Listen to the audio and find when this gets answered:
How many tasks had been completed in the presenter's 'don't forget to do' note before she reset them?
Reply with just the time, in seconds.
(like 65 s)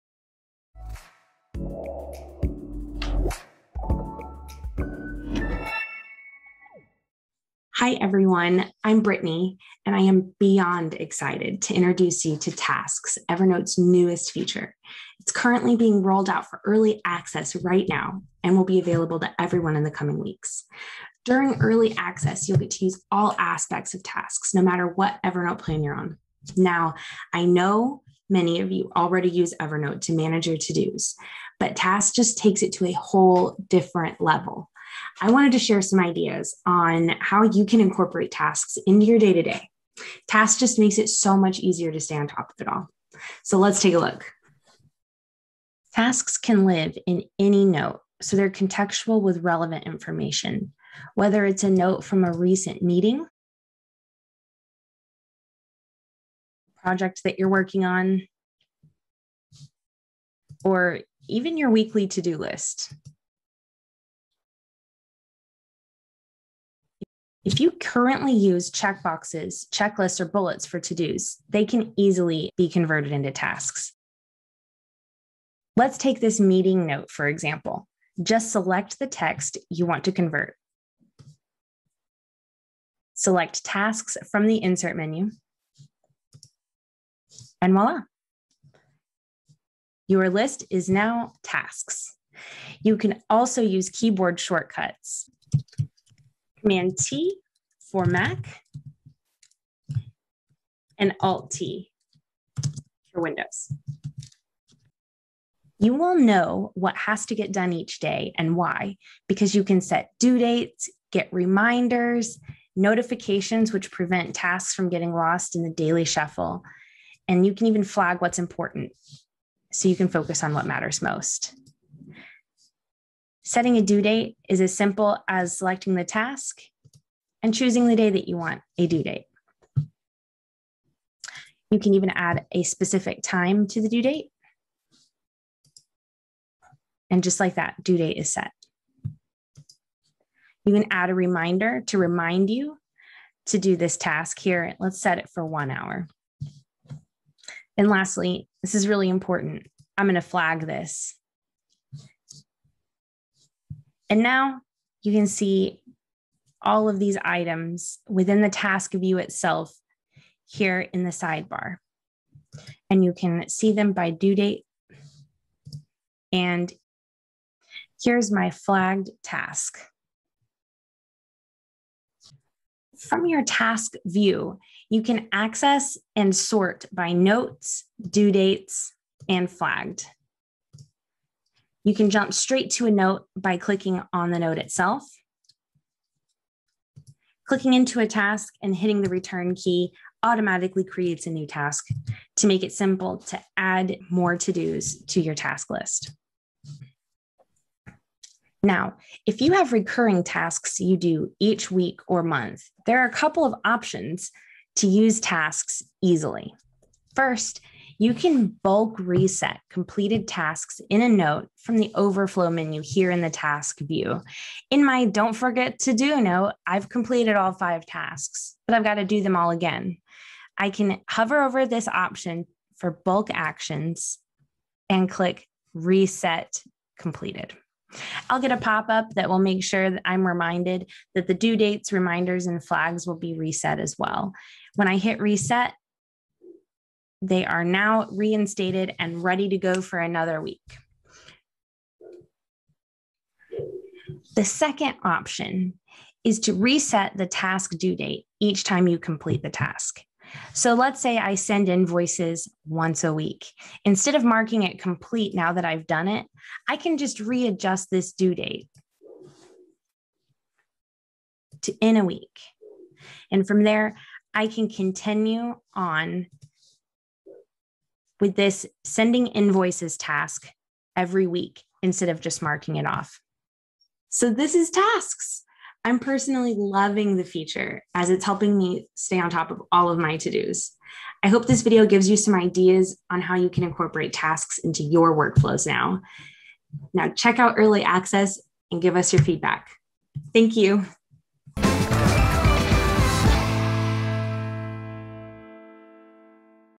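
217 s.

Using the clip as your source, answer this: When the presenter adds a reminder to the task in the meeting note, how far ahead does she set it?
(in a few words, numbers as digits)
1 hour.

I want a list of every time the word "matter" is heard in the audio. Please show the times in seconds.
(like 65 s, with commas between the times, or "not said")
24 s, 120 s.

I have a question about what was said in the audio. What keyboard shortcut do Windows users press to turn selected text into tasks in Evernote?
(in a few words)
Alt T.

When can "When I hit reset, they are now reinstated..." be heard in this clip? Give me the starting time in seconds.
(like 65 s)
234 s.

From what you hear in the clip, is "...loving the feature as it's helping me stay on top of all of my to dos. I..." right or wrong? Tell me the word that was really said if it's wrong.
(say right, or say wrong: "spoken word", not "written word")
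right.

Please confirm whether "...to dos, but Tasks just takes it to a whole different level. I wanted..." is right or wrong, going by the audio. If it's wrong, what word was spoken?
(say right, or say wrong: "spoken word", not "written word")
right.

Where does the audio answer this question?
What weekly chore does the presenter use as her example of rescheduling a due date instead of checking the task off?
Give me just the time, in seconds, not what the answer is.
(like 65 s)
251 s.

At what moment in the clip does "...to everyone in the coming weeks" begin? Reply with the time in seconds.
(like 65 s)
19 s.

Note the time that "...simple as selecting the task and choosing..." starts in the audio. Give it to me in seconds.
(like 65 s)
124 s.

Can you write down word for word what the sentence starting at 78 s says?
Just select the text you want to convert.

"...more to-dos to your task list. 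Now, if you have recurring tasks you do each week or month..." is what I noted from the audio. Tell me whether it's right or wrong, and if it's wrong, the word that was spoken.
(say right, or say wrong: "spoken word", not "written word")
right.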